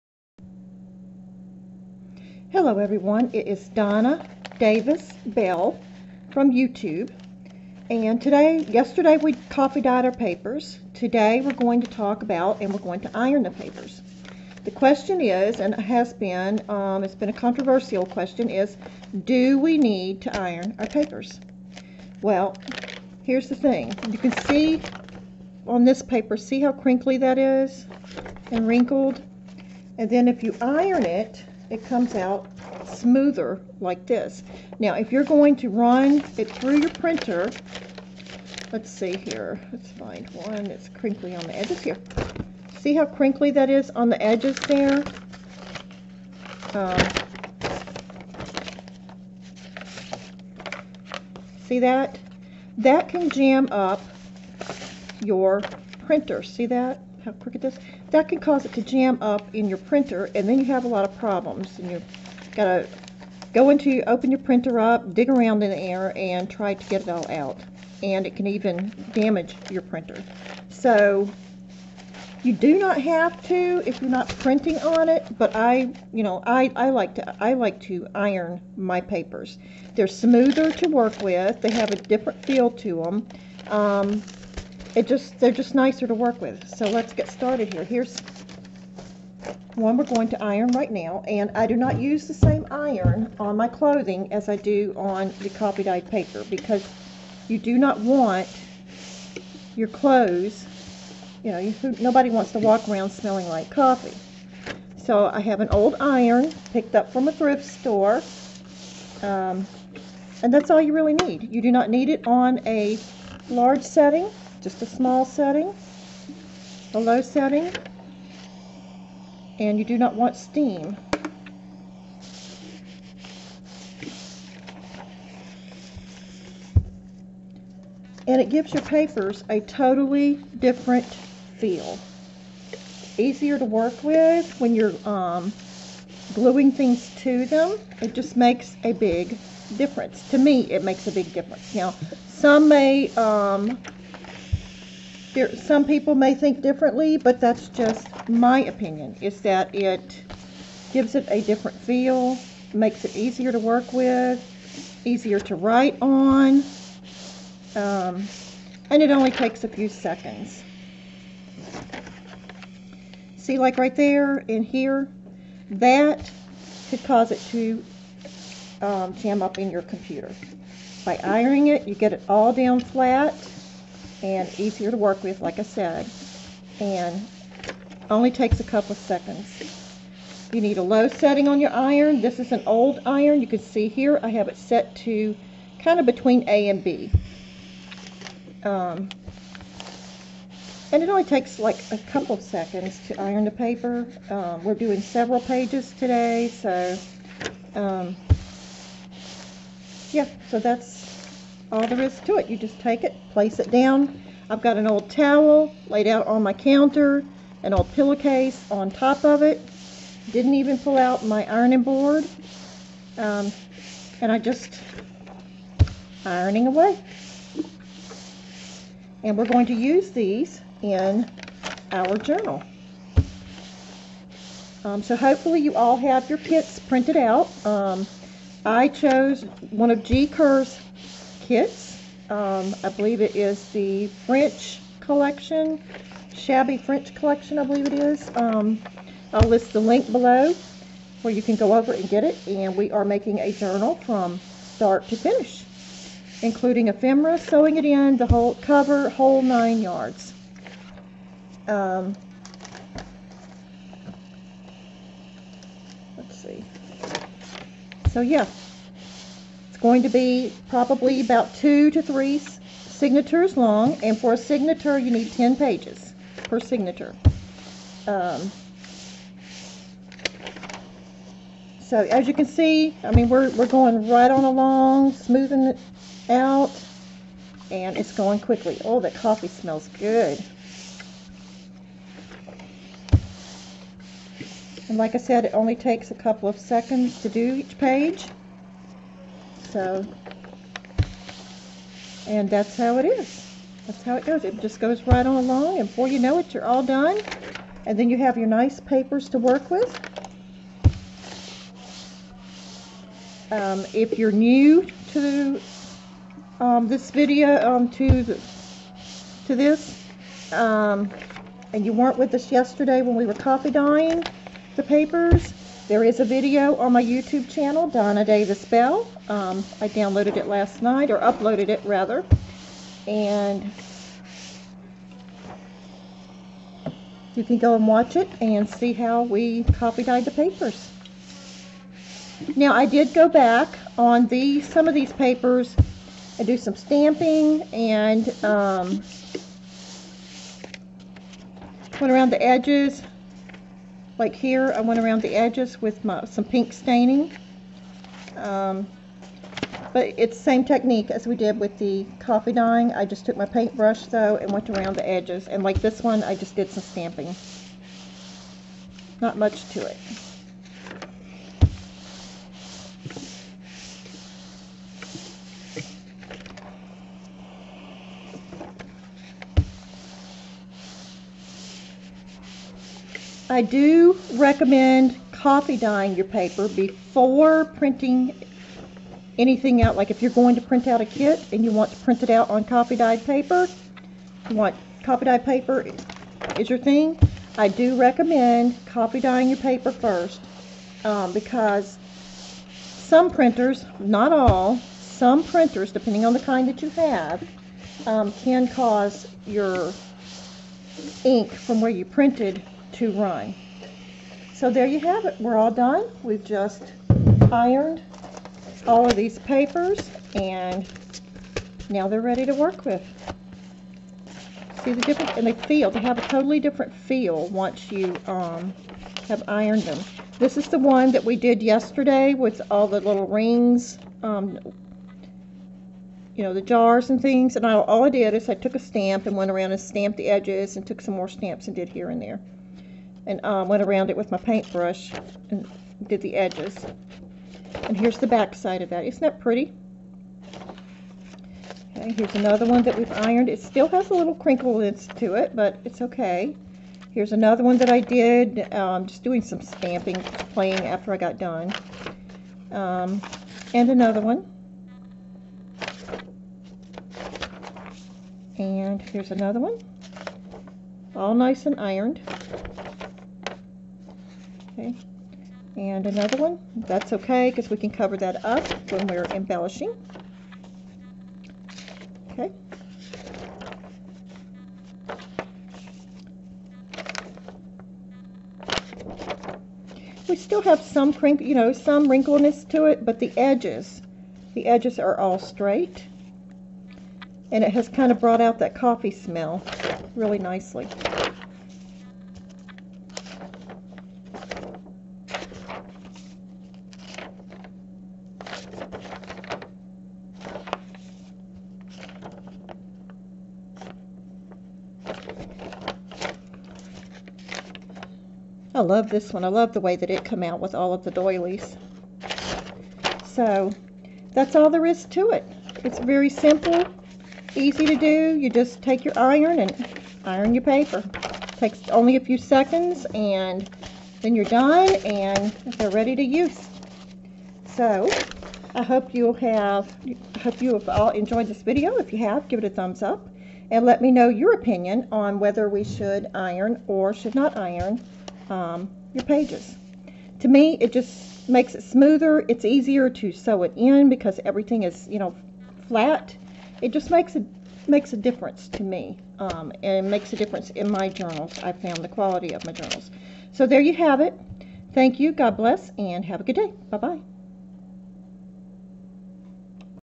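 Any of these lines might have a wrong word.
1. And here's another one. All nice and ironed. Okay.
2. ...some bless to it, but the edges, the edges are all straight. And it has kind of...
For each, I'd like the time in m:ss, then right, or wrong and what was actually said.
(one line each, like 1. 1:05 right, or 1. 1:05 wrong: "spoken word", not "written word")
1. 7:38 right
2. 8:01 wrong: "wrinkliness", not "bless".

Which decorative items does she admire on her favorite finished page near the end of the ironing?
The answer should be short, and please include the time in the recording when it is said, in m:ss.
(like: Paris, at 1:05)
Doilies, at 8:31.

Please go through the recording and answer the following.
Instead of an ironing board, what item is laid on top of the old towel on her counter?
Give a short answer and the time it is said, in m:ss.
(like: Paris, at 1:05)
An old pillowcase, at 3:27.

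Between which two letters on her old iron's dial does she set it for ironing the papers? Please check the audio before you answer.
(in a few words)
A and B.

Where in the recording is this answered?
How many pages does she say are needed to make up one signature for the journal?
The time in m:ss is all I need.
4:25.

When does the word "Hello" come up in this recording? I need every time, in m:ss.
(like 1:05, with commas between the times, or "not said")
0:02.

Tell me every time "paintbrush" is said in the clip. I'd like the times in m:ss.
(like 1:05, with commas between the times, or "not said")
5:53, 7:14.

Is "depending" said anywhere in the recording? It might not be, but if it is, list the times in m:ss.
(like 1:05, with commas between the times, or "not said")
6:35.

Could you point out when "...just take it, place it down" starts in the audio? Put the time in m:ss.
3:22.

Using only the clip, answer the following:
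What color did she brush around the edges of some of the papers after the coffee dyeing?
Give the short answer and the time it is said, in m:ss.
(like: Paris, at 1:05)
Pink, at 5:46.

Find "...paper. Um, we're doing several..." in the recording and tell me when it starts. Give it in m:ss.
3:13.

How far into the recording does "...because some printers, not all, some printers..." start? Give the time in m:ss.
6:31.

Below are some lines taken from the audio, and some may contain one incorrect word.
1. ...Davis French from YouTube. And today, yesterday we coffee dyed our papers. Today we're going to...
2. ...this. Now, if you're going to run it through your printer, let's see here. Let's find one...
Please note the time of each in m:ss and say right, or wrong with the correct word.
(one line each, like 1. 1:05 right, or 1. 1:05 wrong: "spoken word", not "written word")
1. 0:04 wrong: "Bell", not "French"
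2. 0:34 right.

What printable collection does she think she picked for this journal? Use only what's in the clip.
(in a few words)
Shabby French collection.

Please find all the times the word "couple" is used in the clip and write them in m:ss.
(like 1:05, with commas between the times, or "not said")
2:58, 3:11, 4:46.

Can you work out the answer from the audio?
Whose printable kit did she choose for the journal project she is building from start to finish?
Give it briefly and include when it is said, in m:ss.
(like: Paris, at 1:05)
G. Kerr, at 3:50.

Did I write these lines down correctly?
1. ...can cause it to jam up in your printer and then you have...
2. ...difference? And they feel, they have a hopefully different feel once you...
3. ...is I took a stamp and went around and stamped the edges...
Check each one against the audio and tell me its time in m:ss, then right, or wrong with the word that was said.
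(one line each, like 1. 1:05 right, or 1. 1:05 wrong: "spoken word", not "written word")
1. 0:58 right
2. 6:55 wrong: "totally", not "hopefully"
3. 7:08 right.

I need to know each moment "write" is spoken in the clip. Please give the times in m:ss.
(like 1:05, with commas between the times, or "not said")
2:35.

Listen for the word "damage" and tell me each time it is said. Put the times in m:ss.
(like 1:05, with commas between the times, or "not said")
1:09.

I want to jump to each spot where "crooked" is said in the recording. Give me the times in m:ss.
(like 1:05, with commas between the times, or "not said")
0:57.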